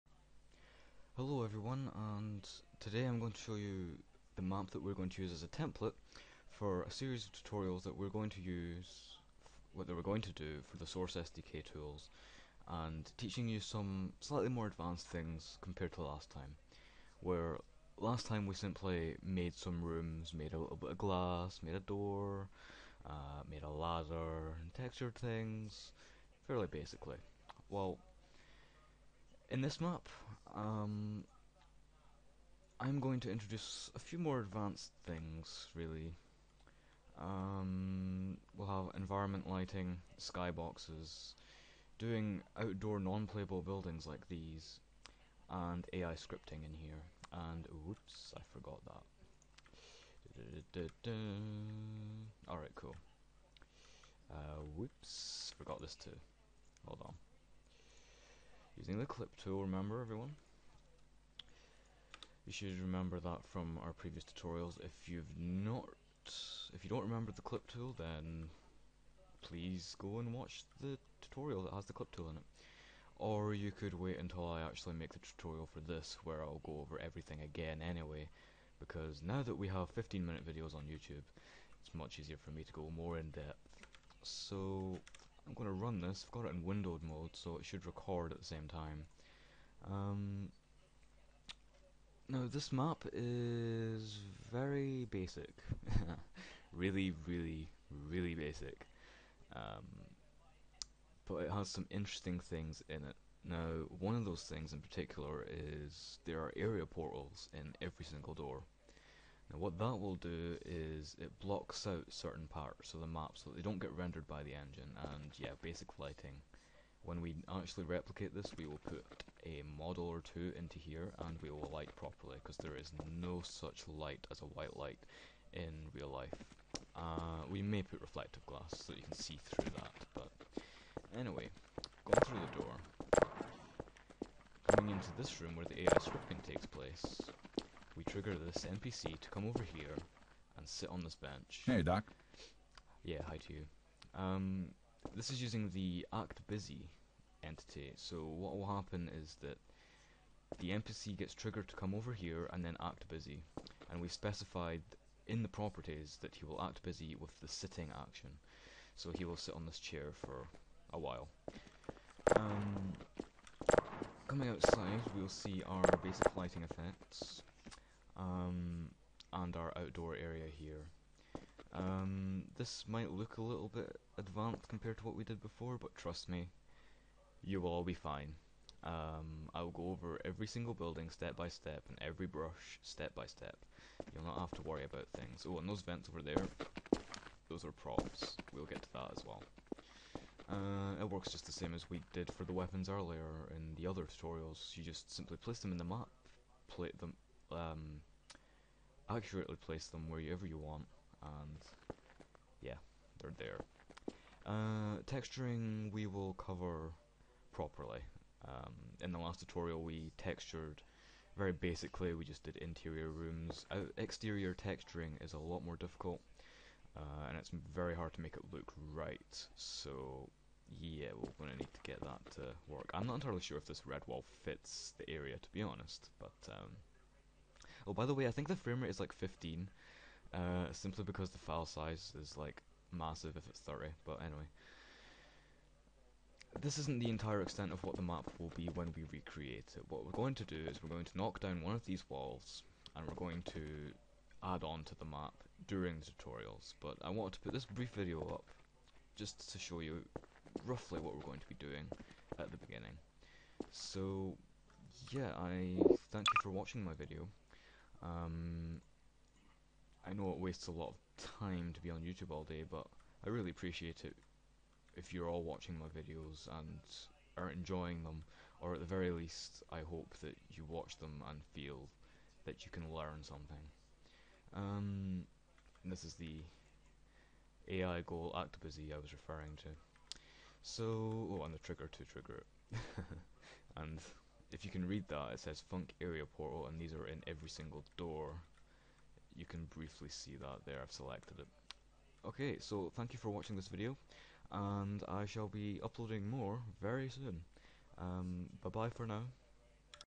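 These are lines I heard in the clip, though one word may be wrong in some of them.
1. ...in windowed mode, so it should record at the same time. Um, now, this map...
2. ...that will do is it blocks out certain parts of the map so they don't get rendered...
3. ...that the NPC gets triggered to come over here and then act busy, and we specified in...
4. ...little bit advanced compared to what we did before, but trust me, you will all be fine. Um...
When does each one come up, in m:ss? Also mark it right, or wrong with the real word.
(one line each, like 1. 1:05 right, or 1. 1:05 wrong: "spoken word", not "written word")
1. 1:26 right
2. 1:49 right
3. 2:29 right
4. 2:53 right.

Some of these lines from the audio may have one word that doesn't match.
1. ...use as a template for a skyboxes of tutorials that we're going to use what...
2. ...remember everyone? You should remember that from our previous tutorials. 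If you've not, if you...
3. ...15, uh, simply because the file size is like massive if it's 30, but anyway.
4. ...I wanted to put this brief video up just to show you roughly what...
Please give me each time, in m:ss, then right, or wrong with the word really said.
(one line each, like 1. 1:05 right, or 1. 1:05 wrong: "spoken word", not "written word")
1. 0:05 wrong: "series", not "skyboxes"
2. 0:59 right
3. 3:49 right
4. 4:07 right.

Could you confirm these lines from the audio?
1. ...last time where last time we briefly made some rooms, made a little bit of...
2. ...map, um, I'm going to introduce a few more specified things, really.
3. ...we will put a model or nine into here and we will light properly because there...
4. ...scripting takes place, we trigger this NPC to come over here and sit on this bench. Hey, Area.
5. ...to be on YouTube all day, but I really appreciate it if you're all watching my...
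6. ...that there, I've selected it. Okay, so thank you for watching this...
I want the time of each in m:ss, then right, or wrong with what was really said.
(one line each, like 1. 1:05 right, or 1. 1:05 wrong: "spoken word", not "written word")
1. 0:16 wrong: "simply", not "briefly"
2. 0:29 wrong: "advanced", not "specified"
3. 1:58 wrong: "two", not "nine"
4. 2:15 wrong: "Doc", not "Area"
5. 4:21 right
6. 4:50 right.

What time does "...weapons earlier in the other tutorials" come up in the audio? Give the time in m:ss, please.
3:12.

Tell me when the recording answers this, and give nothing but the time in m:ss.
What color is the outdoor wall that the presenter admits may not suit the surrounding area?
3:43.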